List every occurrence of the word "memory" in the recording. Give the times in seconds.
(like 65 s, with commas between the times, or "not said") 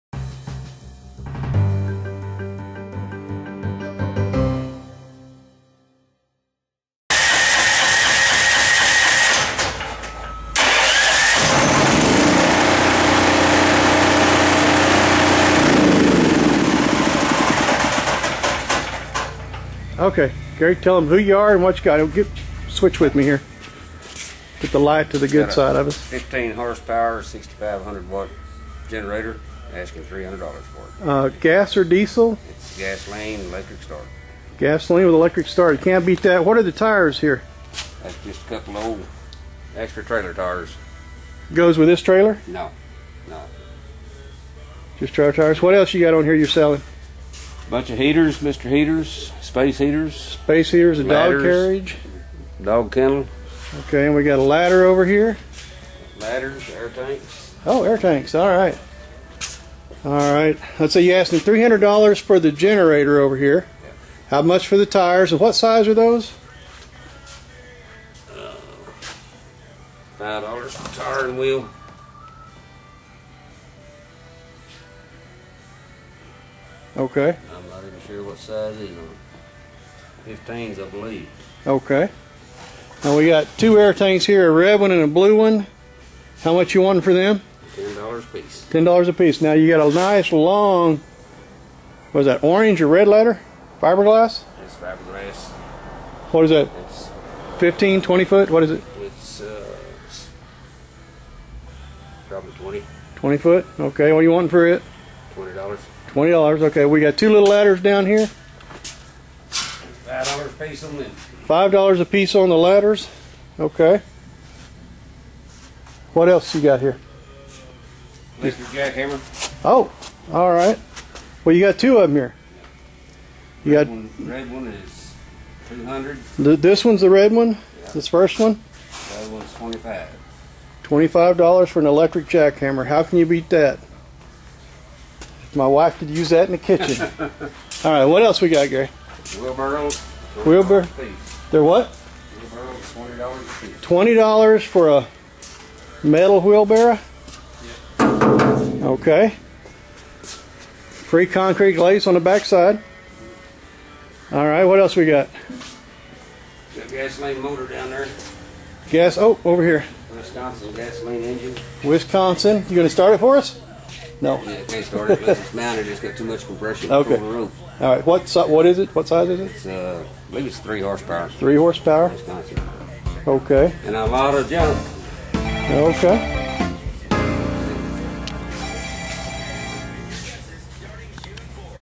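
not said.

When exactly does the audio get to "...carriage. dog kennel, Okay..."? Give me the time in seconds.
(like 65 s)
51 s.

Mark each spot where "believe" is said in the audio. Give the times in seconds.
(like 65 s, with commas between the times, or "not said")
80 s, 170 s.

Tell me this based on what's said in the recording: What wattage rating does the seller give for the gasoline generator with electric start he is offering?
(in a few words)
6,500 watts.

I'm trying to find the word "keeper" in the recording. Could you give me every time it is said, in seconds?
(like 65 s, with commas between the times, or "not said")
not said.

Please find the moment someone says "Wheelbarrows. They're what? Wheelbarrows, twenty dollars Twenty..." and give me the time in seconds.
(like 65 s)
140 s.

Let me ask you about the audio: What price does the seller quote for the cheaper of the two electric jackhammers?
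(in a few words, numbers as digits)
$25.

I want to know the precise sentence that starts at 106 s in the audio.
Okay, we got two little ladders down here.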